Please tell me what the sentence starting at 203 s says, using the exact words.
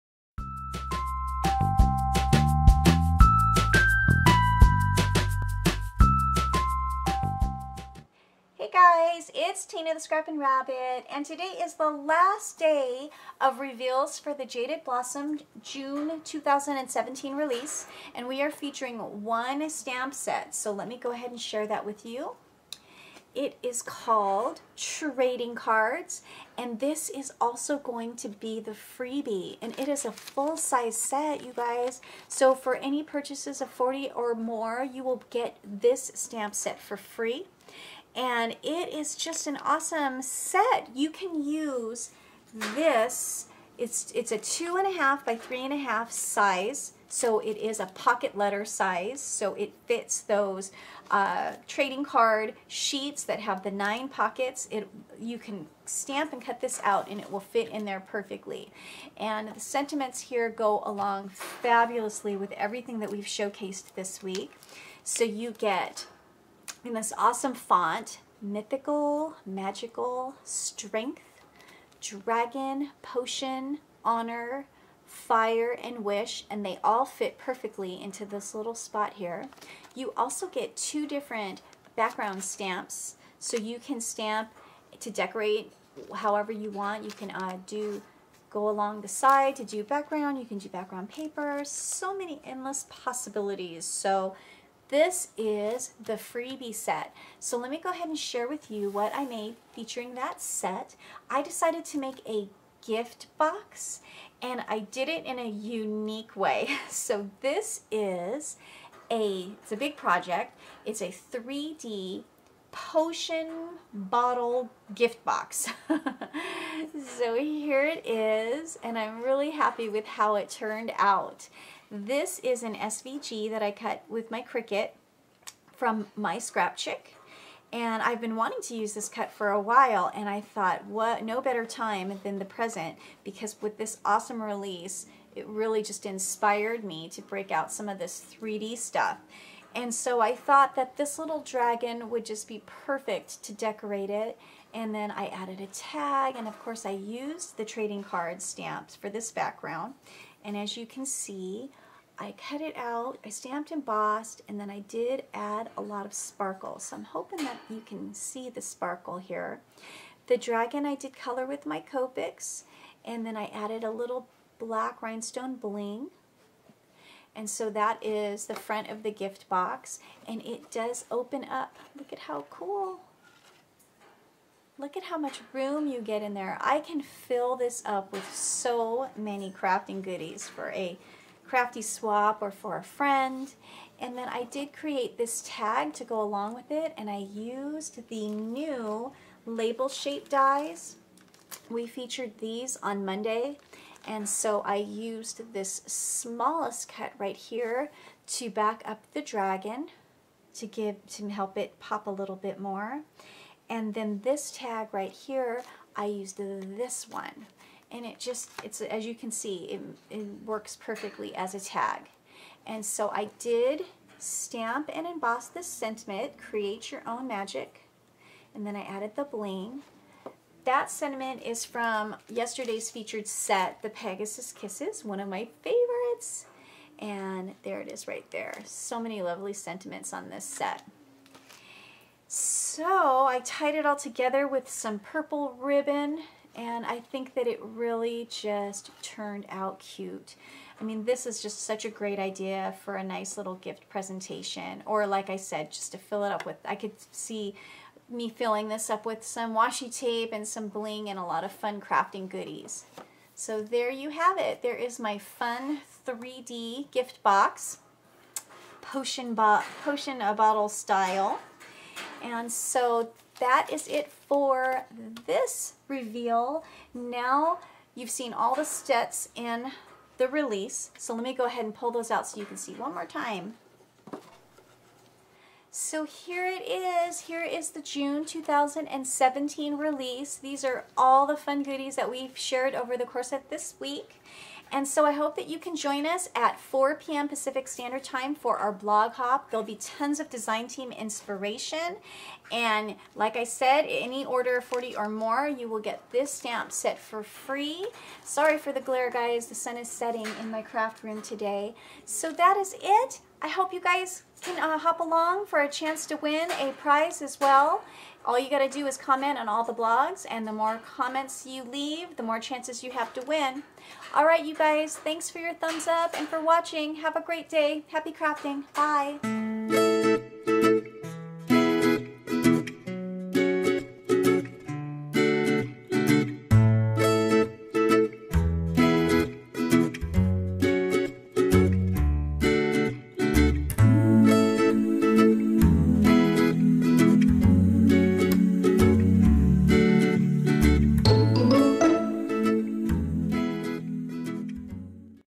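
And then this tag right here, I used this one.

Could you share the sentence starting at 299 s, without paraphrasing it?
The sun is setting in my craft room today.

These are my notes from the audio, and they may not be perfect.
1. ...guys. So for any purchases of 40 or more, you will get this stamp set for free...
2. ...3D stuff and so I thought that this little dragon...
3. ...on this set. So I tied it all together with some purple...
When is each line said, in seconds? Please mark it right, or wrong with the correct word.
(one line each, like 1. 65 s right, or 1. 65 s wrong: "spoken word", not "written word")
1. 31 s right
2. 138 s right
3. 230 s right.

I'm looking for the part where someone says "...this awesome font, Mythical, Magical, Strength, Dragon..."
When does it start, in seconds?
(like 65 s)
66 s.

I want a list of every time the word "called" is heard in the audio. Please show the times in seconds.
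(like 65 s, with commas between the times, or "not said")
23 s.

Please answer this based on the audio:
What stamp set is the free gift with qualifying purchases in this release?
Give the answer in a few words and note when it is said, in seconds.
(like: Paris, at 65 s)
Trading Cards, at 24 s.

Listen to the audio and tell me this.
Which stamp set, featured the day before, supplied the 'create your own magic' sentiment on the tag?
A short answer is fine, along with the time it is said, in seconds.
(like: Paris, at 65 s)
Pegasus Kisses, at 223 s.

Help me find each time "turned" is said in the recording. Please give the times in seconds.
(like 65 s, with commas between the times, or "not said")
120 s, 239 s.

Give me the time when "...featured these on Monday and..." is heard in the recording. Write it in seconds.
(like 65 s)
191 s.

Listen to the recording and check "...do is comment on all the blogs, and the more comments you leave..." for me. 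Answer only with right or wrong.
right.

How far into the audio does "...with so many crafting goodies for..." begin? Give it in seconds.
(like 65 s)
178 s.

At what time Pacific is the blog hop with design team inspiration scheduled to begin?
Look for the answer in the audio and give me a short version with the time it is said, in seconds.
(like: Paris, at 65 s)
4 p.m., at 286 s.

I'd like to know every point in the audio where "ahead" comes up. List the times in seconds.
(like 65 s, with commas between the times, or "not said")
21 s, 97 s, 271 s.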